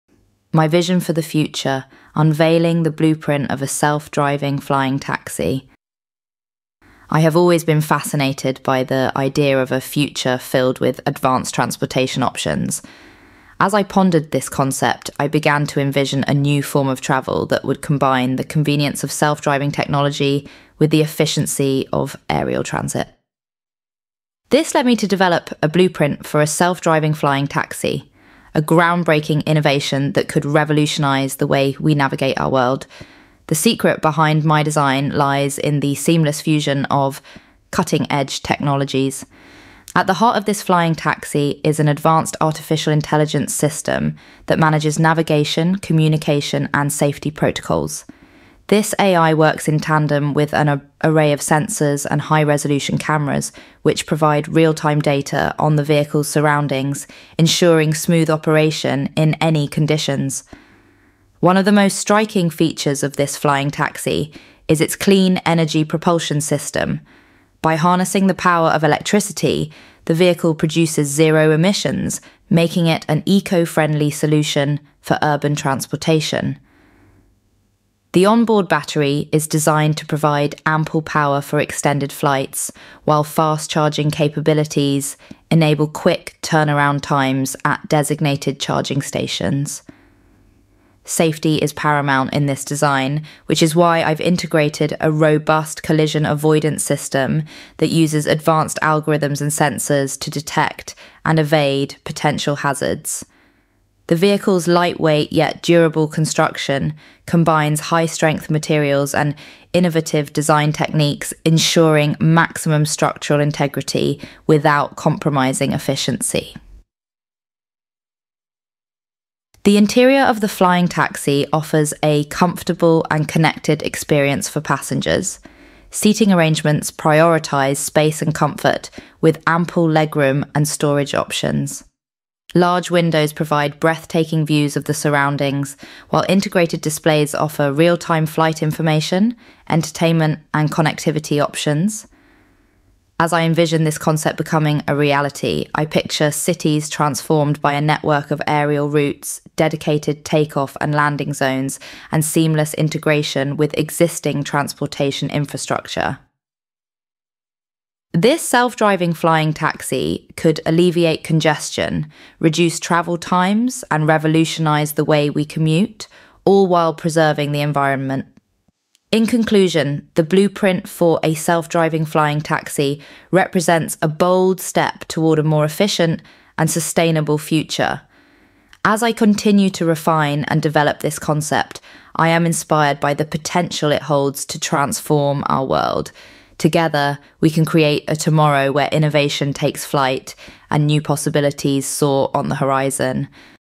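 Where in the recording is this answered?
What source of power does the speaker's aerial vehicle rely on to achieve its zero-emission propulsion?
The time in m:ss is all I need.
1:08.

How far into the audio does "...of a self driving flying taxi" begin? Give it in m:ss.
0:03.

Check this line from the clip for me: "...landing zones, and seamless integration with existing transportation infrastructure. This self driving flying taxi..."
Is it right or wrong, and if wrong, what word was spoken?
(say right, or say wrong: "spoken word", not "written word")
right.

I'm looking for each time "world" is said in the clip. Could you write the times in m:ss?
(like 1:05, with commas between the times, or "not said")
0:32, 3:05.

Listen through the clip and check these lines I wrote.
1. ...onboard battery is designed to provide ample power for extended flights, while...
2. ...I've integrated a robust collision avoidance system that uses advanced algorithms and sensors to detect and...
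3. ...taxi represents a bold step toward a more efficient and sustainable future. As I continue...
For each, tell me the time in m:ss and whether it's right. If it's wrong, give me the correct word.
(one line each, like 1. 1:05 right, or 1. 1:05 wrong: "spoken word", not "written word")
1. 1:18 right
2. 1:34 right
3. 2:52 right.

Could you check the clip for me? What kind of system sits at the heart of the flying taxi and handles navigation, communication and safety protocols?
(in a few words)
artificial intelligence system.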